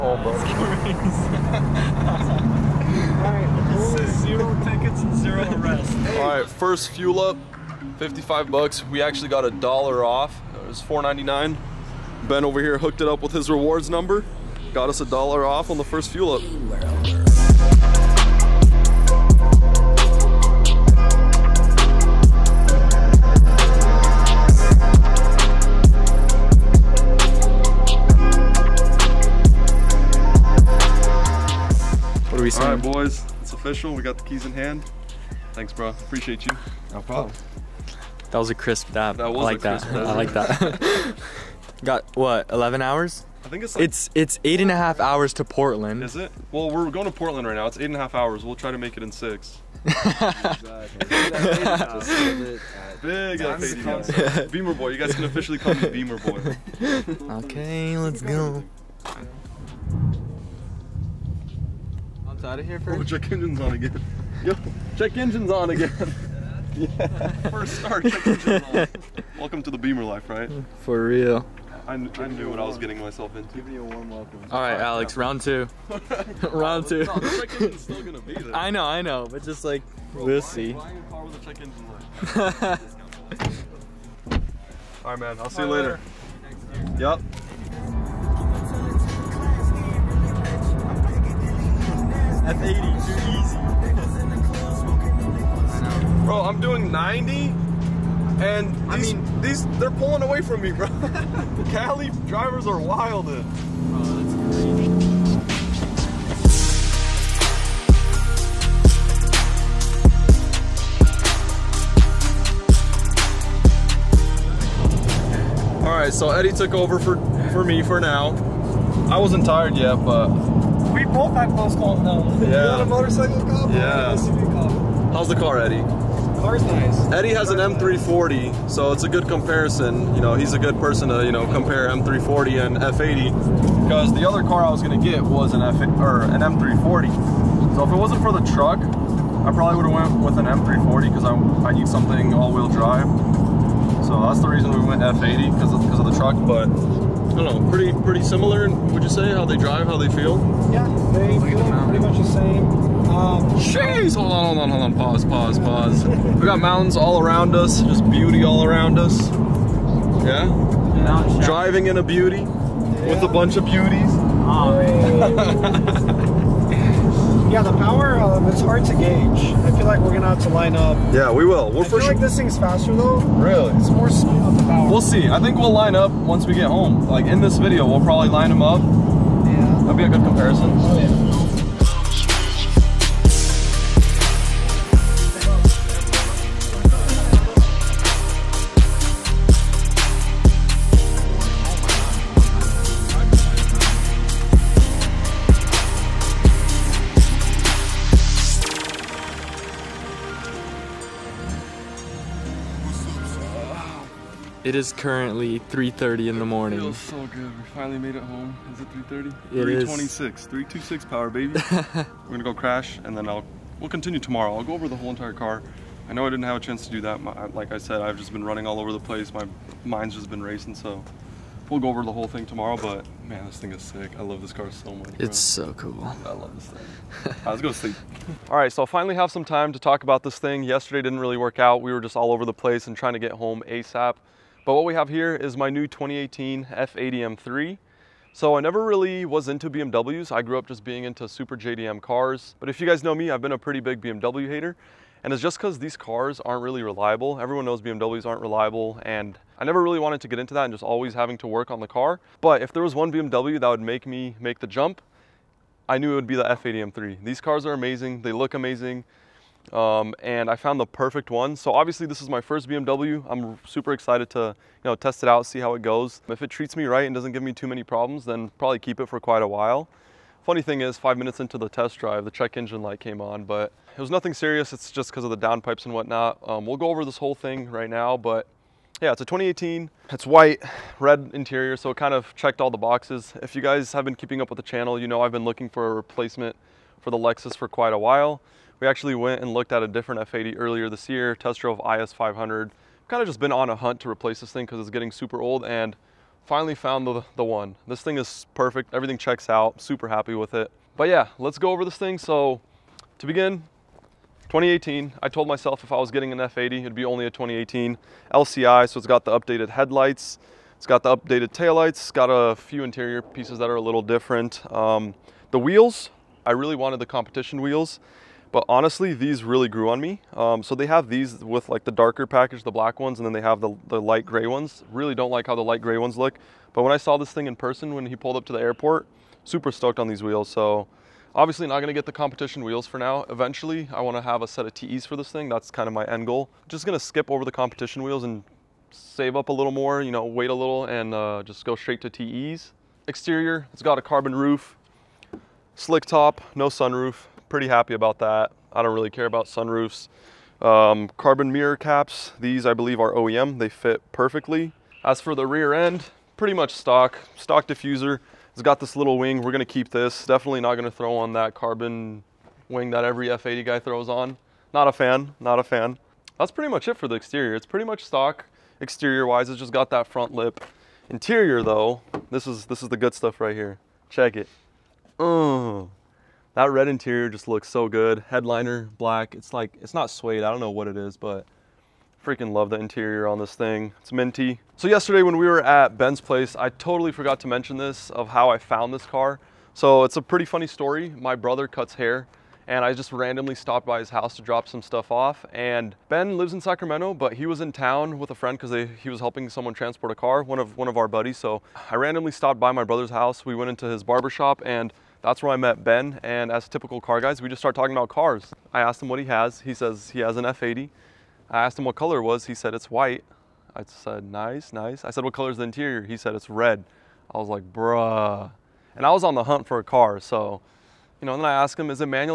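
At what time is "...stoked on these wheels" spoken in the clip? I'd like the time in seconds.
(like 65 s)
329 s.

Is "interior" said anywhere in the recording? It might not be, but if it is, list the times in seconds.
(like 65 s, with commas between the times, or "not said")
281 s, 312 s, 371 s, 376 s, 382 s, 415 s.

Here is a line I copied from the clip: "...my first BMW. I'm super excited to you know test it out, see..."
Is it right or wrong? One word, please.
right.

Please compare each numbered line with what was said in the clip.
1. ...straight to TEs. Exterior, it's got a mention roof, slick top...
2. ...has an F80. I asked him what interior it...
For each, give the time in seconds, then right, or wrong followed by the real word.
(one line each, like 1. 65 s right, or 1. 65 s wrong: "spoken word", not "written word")
1. 341 s wrong: "carbon", not "mention"
2. 410 s wrong: "color", not "interior".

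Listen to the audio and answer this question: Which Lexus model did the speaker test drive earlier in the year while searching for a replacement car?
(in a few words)
IS500.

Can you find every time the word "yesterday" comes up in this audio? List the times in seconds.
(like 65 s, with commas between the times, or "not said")
230 s, 384 s.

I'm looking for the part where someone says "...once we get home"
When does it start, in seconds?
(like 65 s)
176 s.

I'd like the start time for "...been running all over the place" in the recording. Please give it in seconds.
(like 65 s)
218 s.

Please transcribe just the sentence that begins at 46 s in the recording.
Well, we're going to Portland right now.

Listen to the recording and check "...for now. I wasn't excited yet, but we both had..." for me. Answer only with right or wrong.
wrong.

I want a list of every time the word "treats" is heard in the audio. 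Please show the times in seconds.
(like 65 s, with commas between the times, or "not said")
266 s.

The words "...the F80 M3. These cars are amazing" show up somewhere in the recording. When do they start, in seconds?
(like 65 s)
256 s.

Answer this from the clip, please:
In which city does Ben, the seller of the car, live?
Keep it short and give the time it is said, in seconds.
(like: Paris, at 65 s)
Sacramento, at 396 s.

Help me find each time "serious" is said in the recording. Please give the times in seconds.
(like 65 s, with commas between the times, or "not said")
274 s.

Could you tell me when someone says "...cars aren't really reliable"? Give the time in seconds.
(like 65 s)
245 s.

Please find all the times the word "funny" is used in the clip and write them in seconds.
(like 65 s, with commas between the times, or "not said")
270 s, 390 s.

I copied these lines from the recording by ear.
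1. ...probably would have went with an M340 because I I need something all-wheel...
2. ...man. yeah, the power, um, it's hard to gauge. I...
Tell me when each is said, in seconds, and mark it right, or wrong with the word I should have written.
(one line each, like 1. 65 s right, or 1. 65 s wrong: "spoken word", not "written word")
1. 139 s right
2. 164 s right.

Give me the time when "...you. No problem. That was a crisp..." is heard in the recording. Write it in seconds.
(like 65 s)
36 s.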